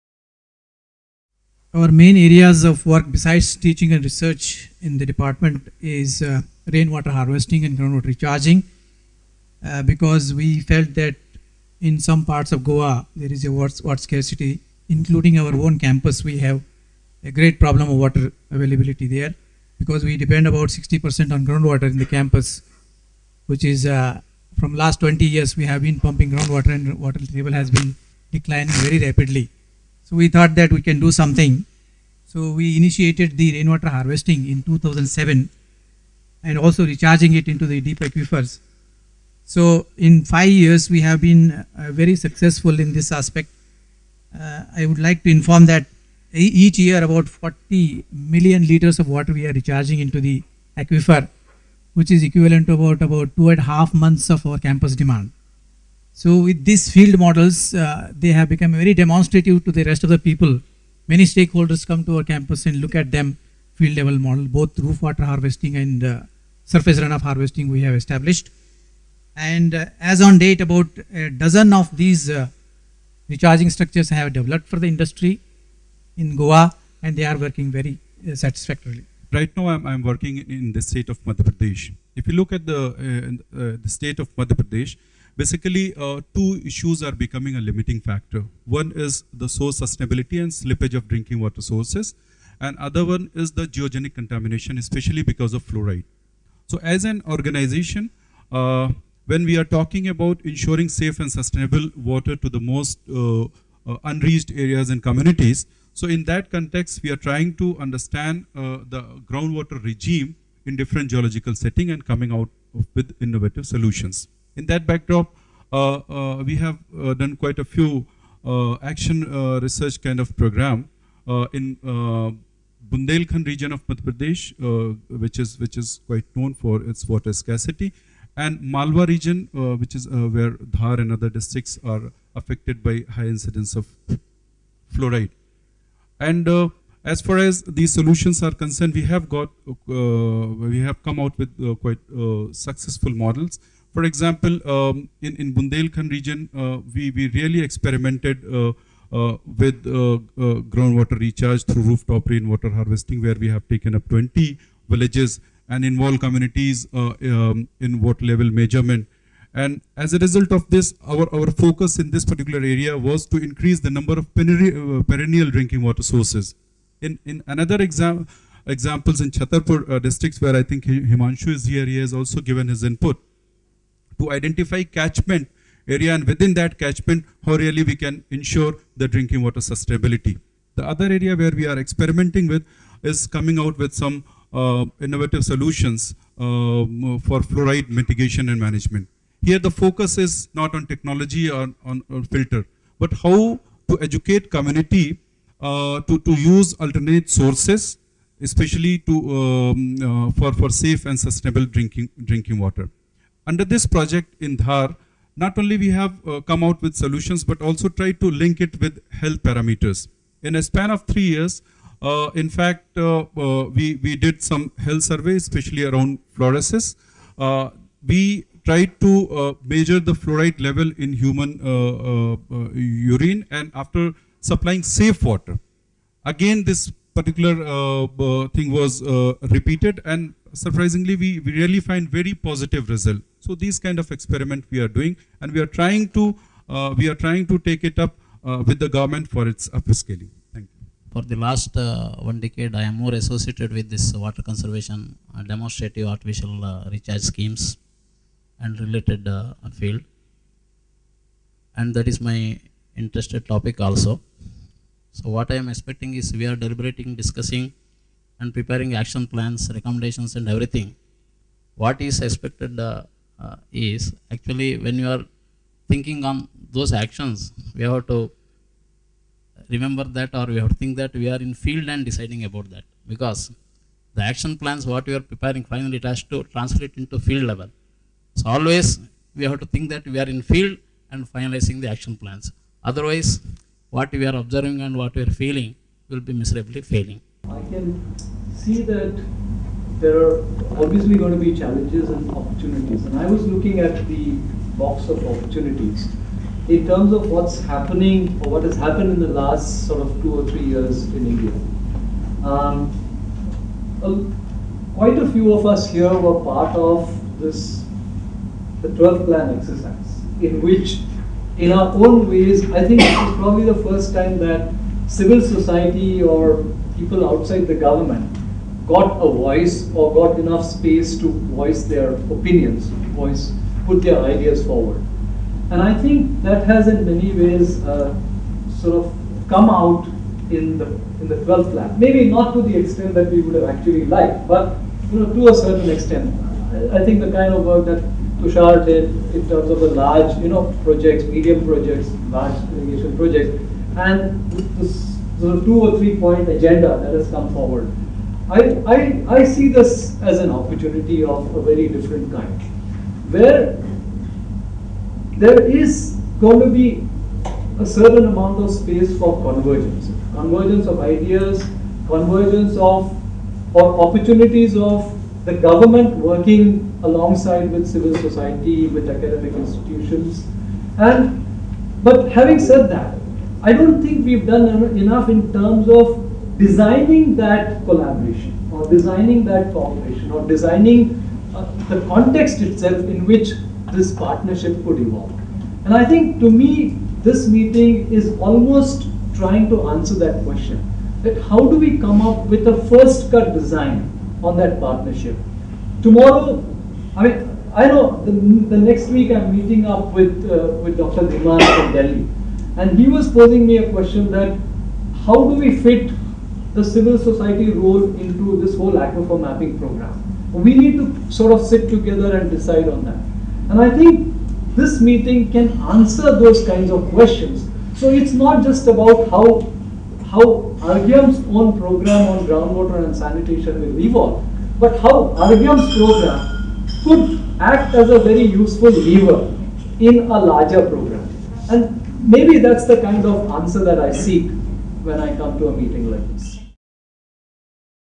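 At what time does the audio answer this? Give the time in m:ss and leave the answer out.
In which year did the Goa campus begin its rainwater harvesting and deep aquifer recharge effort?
0:34.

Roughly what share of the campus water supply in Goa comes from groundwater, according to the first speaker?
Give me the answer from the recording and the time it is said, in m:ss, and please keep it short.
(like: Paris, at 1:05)
60%, at 0:20.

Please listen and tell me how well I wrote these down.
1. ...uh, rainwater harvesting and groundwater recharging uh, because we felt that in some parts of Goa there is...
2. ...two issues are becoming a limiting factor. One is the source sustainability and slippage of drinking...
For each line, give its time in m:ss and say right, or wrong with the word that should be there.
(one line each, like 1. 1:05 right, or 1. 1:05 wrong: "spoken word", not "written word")
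1. 0:06 right
2. 1:26 right.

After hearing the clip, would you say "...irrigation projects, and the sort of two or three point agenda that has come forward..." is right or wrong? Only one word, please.
right.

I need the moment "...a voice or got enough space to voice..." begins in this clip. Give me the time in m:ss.
5:19.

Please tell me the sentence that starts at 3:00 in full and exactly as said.
The other area where we are experimenting with is coming out with some uh, innovative solutions um, for fluoride mitigation and management.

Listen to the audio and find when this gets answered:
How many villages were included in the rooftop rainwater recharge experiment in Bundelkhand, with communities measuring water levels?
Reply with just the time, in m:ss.
2:34.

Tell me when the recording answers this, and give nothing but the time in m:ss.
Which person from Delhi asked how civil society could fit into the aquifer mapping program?
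6:40.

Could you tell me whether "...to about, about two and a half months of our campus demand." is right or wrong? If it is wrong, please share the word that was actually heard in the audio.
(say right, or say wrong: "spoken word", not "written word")
right.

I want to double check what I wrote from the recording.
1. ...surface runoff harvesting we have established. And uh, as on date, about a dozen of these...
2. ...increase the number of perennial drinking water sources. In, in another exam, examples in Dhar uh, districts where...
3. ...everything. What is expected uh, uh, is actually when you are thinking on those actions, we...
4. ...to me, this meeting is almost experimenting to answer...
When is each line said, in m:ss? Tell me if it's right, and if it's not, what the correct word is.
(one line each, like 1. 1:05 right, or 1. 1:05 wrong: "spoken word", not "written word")
1. 1:06 right
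2. 2:43 wrong: "Chhatarpur", not "Dhar"
3. 4:20 right
4. 6:26 wrong: "trying", not "experimenting".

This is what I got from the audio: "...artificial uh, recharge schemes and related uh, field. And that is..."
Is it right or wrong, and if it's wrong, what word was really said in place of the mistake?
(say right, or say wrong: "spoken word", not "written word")
right.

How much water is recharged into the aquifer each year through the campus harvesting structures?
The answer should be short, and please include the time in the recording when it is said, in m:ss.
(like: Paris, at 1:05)
40 million liters, at 0:47.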